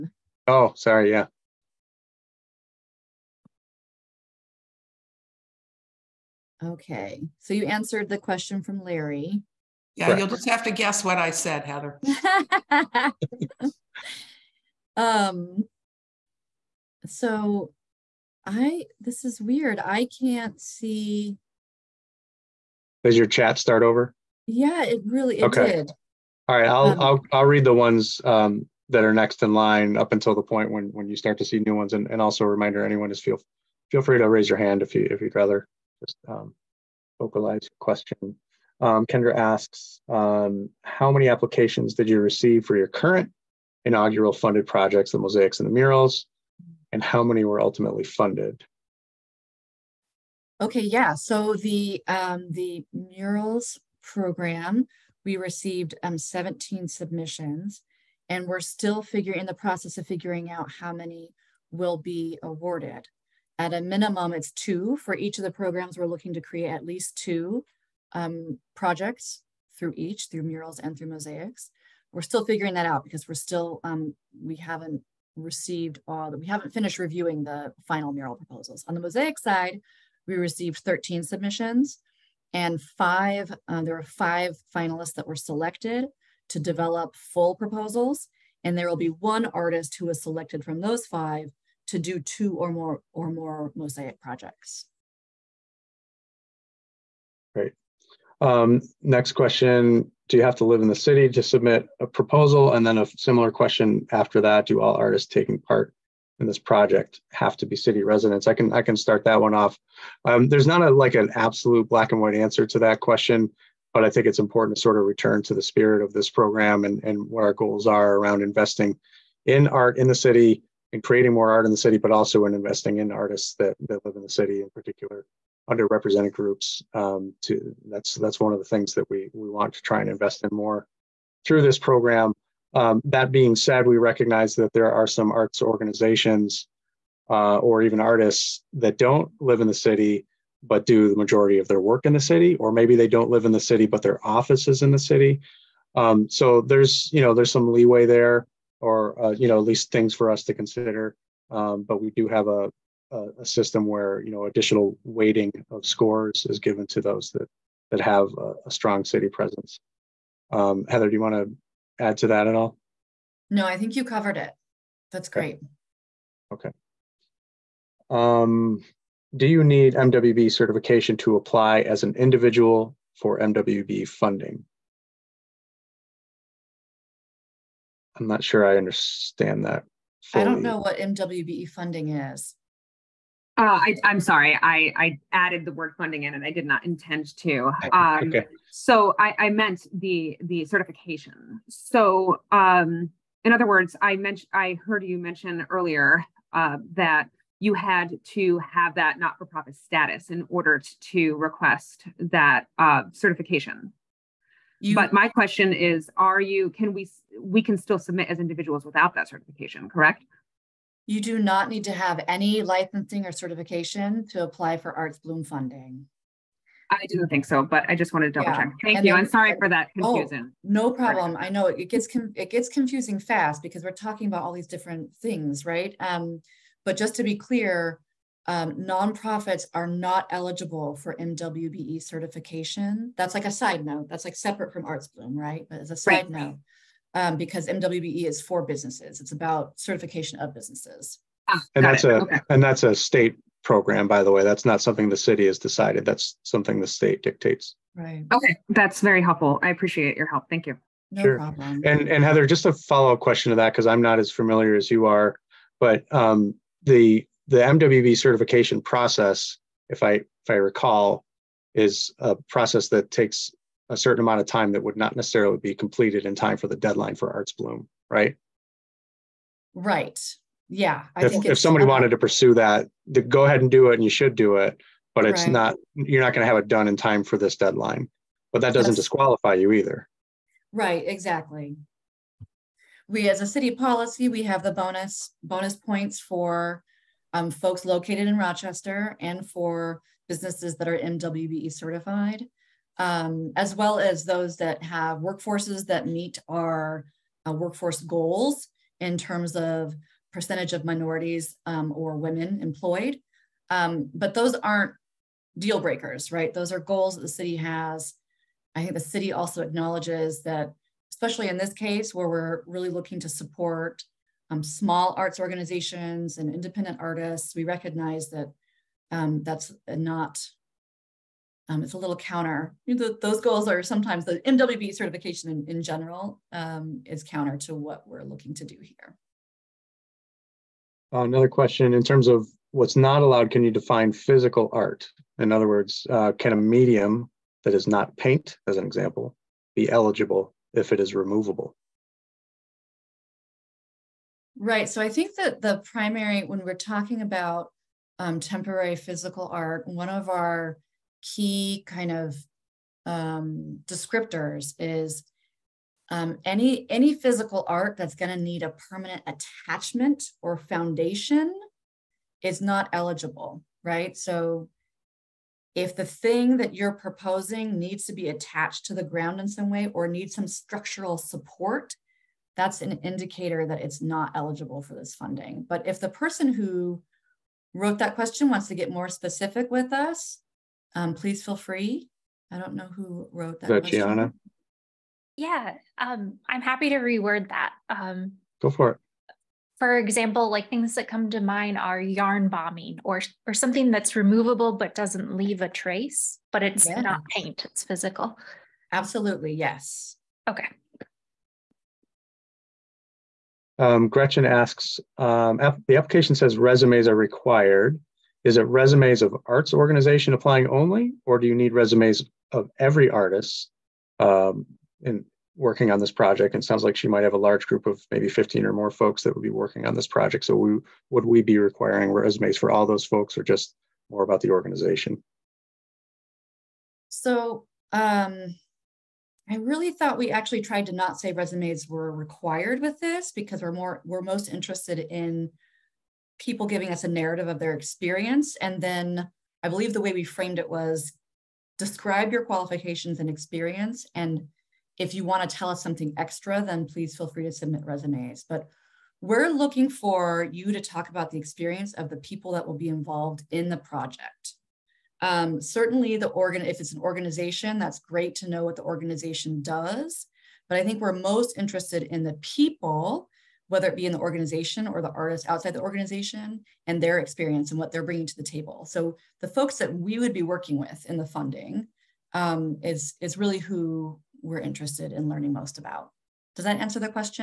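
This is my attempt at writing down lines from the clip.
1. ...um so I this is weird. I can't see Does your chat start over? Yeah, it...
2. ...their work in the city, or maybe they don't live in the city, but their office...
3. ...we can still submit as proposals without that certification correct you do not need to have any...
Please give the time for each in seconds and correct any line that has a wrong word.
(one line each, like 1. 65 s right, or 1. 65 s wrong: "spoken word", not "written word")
1. 14 s right
2. 141 s right
3. 207 s wrong: "individuals", not "proposals".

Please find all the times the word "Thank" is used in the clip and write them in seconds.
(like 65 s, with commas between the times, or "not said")
218 s, 250 s.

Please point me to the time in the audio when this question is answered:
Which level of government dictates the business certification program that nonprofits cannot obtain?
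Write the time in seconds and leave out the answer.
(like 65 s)
242 s.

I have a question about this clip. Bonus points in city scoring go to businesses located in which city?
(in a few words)
Rochester.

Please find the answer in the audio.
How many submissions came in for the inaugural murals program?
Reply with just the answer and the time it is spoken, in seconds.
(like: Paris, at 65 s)
17, at 56 s.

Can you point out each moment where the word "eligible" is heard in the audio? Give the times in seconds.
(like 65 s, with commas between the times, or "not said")
230 s, 339 s, 362 s, 374 s.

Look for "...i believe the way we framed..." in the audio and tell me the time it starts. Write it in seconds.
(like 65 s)
439 s.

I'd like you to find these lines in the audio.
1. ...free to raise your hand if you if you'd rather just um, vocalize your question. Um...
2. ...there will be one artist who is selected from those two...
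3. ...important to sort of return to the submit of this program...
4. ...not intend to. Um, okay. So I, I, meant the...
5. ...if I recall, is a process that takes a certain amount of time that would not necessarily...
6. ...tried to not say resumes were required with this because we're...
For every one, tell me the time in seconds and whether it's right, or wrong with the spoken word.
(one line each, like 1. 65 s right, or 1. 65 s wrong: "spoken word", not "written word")
1. 34 s right
2. 88 s wrong: "five", not "two"
3. 114 s wrong: "spirit", not "submit"
4. 186 s right
5. 260 s right
6. 430 s right.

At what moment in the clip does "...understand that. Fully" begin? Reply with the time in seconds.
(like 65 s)
178 s.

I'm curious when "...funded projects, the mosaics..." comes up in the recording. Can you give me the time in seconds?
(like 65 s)
44 s.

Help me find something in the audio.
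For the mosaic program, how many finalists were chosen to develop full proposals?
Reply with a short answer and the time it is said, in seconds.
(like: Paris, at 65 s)
5, at 84 s.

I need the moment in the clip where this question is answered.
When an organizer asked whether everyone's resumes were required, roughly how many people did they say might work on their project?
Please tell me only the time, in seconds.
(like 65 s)
418 s.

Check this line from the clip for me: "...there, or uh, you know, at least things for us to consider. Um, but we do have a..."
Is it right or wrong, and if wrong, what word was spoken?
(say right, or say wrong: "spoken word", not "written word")
right.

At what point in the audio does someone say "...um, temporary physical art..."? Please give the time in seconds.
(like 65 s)
348 s.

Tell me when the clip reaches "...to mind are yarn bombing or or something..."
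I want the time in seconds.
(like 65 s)
391 s.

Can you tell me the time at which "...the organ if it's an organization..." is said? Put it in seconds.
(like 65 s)
456 s.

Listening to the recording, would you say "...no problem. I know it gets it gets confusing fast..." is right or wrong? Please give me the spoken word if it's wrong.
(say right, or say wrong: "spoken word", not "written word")
right.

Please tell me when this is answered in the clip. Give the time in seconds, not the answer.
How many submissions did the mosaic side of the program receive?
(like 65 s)
80 s.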